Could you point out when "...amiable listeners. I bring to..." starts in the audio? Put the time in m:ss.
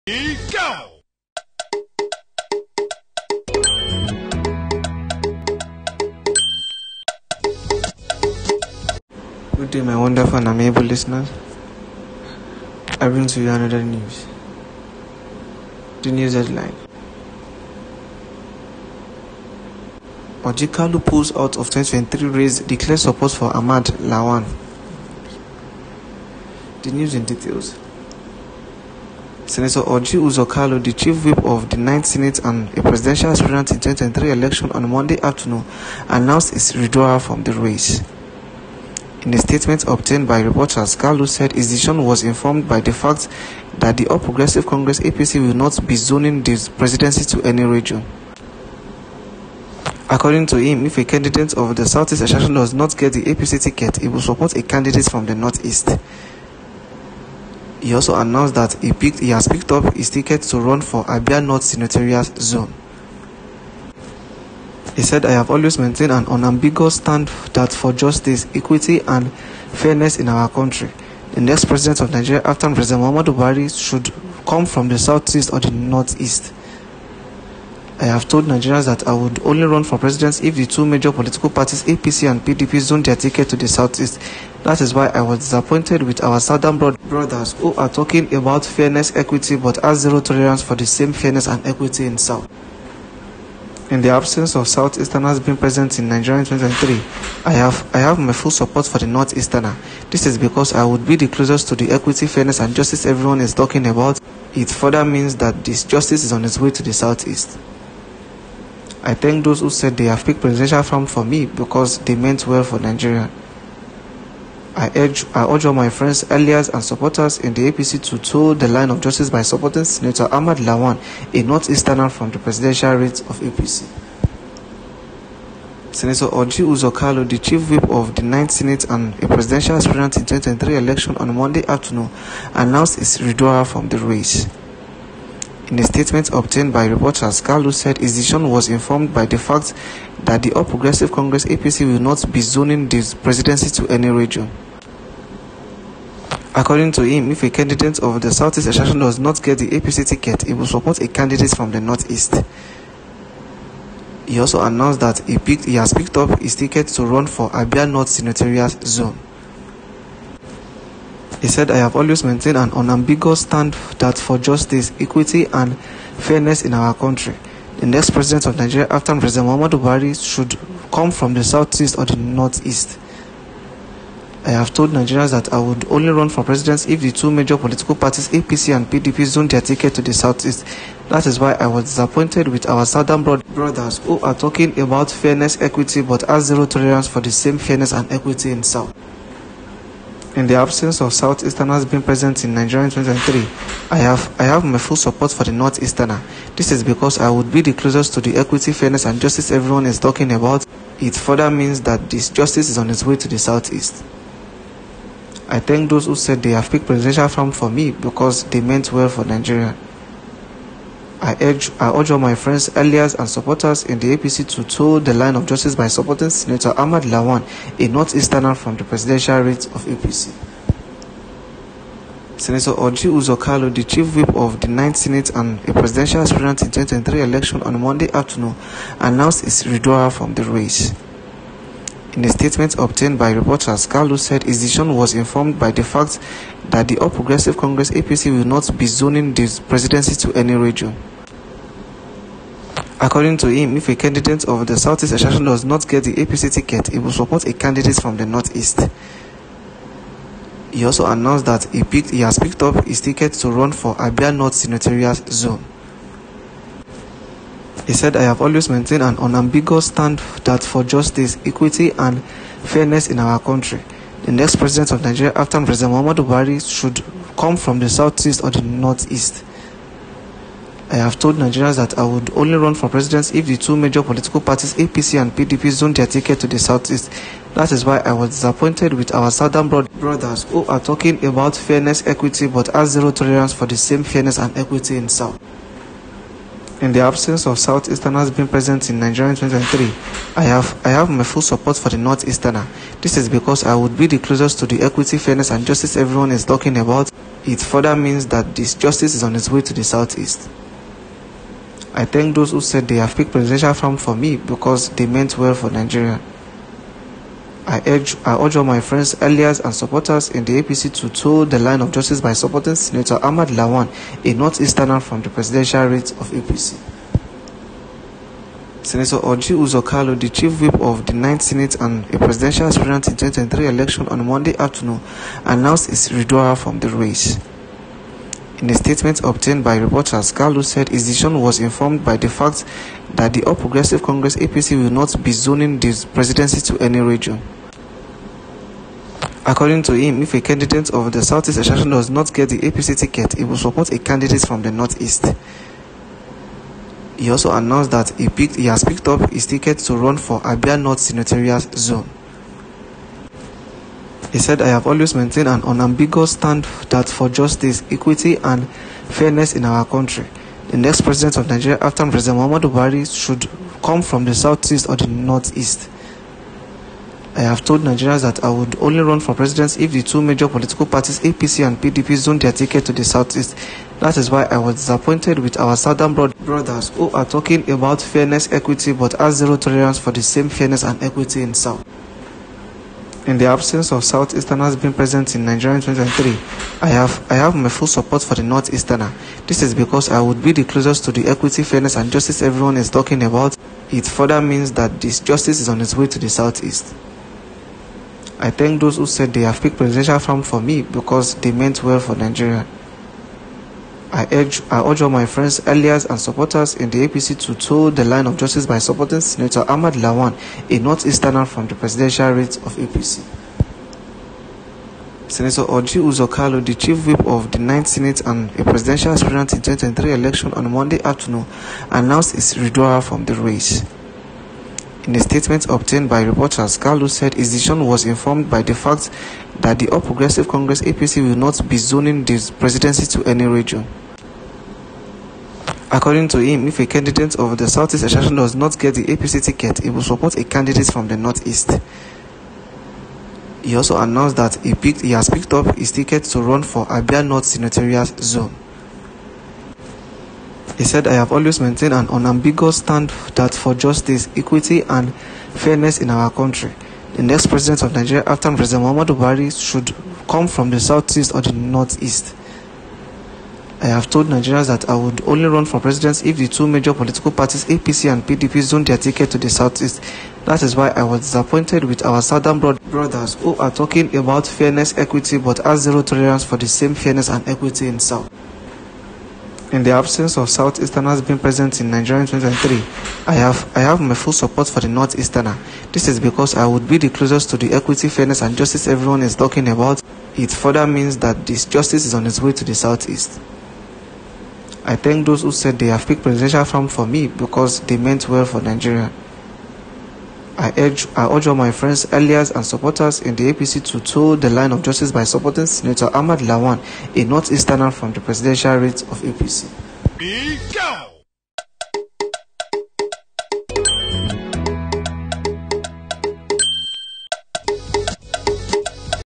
0:10.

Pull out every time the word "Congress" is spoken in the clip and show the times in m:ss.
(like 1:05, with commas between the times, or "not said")
0:44, 2:21, 3:57, 5:34, 7:10.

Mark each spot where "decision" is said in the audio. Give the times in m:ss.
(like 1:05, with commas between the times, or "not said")
0:41, 2:18, 3:54, 5:31, 7:07.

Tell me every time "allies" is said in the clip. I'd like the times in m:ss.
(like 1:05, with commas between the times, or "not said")
1:56, 3:32, 5:09, 6:45, 8:22.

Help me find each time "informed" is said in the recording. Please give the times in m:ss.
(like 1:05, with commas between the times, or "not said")
0:42, 2:18, 3:55, 5:31, 7:08.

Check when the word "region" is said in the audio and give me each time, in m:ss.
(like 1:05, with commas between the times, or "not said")
0:47, 2:24, 4:00, 5:36, 7:13.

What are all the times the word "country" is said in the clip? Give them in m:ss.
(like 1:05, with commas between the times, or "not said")
1:10, 2:46, 4:23, 5:59, 7:36.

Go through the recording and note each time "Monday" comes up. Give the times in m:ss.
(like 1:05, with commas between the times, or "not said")
0:34, 2:11, 3:47, 5:24, 7:00.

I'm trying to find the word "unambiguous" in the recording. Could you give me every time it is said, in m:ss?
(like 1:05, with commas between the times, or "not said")
1:06, 2:42, 4:19, 5:55, 7:32.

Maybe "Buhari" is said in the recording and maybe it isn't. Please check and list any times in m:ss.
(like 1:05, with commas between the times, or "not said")
1:13, 2:49, 4:26, 6:02, 7:39.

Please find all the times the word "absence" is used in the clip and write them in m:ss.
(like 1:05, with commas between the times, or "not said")
1:34, 3:10, 4:46, 6:23, 7:59.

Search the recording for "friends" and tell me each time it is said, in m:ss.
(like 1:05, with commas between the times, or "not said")
1:55, 3:32, 5:08, 6:45, 8:21.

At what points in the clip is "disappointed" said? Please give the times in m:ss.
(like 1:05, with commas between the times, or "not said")
1:25, 3:01, 4:38, 6:14, 7:51.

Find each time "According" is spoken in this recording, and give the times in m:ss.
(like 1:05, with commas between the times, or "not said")
0:50, 2:26, 4:02, 5:39, 7:15.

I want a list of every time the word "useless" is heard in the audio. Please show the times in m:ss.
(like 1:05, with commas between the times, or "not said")
not said.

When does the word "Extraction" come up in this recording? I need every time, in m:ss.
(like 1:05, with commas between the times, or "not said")
2:28.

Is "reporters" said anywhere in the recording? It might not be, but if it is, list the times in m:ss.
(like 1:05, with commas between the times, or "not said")
0:40, 2:16, 3:53, 5:29, 7:06.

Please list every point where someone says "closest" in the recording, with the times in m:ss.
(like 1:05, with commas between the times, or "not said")
1:41, 3:17, 4:54, 6:30, 8:07.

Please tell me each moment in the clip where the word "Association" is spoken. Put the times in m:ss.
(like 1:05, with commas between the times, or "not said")
0:52, 4:05, 5:41, 7:18.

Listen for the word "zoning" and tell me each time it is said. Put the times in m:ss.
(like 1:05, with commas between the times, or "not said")
0:45, 2:22, 3:58, 5:35, 7:11.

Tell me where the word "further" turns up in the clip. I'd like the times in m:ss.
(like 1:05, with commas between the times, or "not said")
1:44, 3:21, 4:57, 6:34, 8:10.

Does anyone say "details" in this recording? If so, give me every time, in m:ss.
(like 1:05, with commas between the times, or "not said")
0:27.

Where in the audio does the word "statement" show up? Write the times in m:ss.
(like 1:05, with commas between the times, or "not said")
0:39, 2:15, 3:52, 5:28, 7:05.